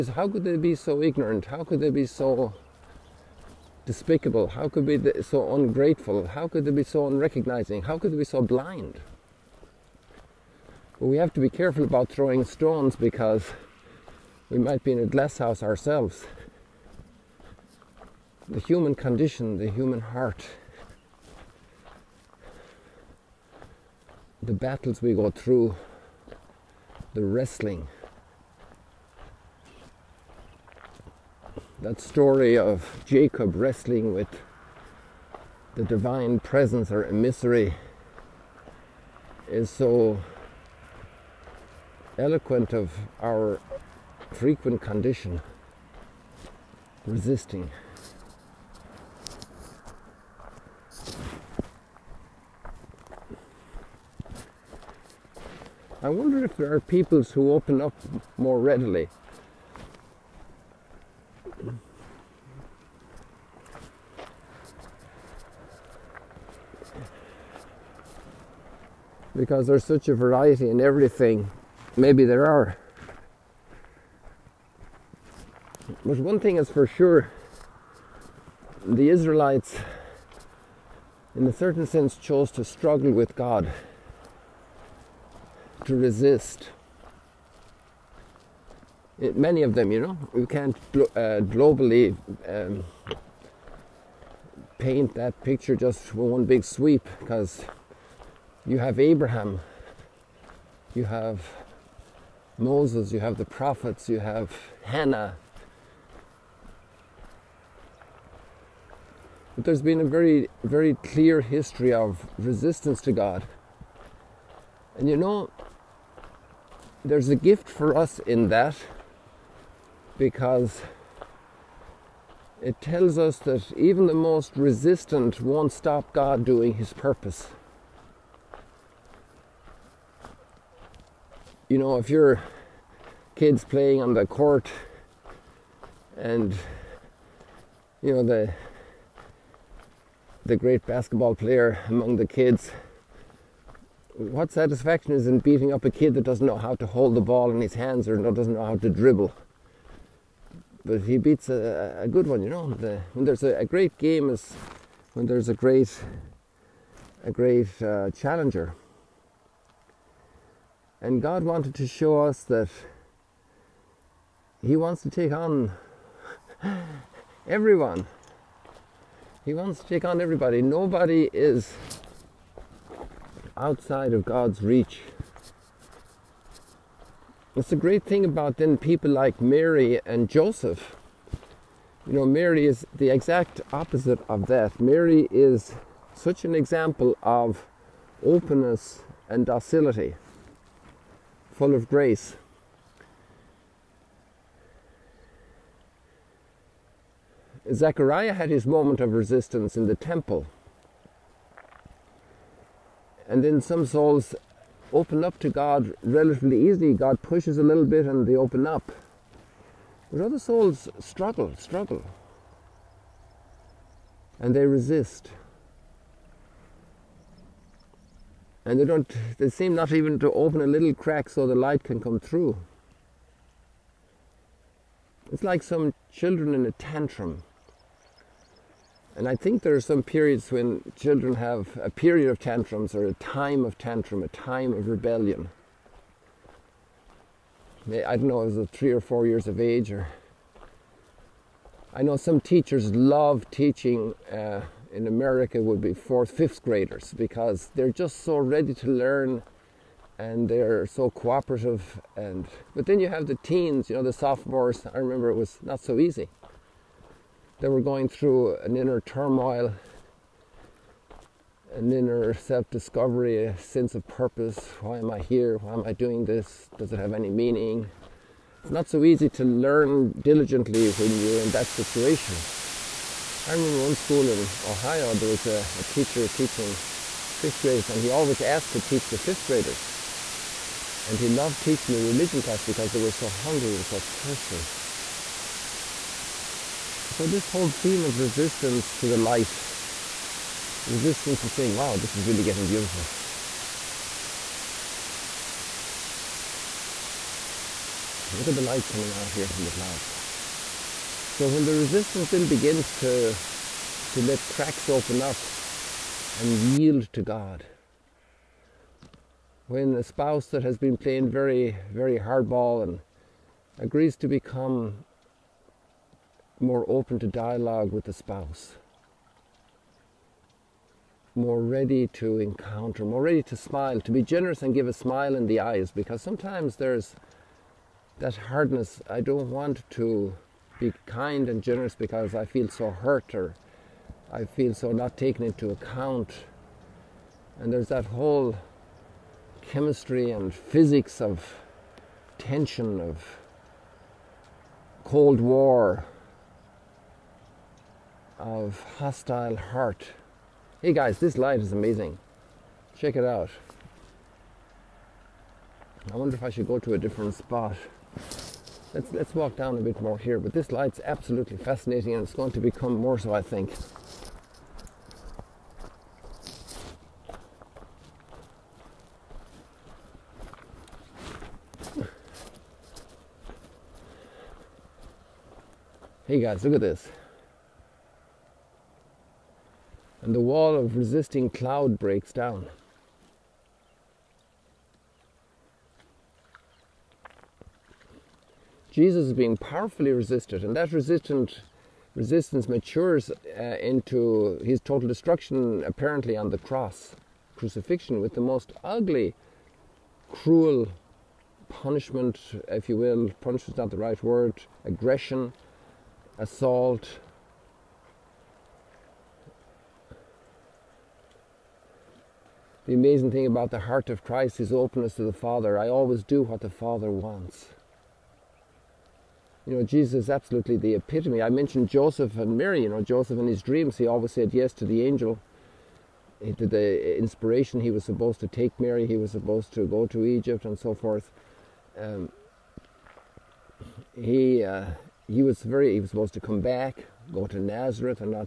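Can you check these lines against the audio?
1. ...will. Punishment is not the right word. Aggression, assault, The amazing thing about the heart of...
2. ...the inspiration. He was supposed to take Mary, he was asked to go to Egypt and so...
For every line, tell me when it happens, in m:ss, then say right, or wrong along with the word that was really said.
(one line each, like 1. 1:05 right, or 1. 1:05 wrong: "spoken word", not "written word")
1. 6:42 right
2. 7:06 wrong: "supposed", not "asked".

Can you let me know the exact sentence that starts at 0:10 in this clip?
But we have to be careful about throwing stones because we might be in a glass house ourselves.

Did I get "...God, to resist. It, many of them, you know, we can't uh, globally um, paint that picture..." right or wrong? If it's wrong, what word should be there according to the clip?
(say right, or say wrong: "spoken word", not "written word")
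right.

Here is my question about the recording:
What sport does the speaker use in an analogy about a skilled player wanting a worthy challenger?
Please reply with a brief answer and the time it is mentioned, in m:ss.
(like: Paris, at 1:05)
basketball, at 2:20.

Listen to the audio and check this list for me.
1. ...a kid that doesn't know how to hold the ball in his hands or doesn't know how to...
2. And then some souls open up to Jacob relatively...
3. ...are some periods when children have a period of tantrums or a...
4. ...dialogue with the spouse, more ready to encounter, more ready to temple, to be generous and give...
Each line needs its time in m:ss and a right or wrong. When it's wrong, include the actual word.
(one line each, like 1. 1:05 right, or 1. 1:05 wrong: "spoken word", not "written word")
1. 2:25 right
2. 3:23 wrong: "God", not "Jacob"
3. 3:49 right
4. 5:17 wrong: "smile", not "temple".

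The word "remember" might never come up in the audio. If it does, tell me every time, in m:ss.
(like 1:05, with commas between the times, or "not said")
4:14, 4:33.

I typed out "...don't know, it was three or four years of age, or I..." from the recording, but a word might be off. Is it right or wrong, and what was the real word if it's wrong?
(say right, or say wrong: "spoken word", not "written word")
right.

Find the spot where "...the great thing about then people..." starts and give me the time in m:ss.
2:57.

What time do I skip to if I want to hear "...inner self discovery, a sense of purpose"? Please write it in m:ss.
4:21.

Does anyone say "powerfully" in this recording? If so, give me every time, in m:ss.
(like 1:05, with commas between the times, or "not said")
6:29.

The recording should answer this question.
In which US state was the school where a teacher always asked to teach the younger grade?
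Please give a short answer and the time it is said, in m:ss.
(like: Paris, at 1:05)
Ohio, at 4:34.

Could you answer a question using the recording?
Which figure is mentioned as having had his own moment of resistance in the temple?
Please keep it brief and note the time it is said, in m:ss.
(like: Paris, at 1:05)
Zechariah, at 3:17.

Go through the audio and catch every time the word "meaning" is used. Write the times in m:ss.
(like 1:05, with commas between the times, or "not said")
4:27.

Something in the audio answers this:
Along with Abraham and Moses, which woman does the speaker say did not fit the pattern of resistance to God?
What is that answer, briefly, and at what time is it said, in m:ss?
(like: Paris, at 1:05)
Hannah, at 1:44.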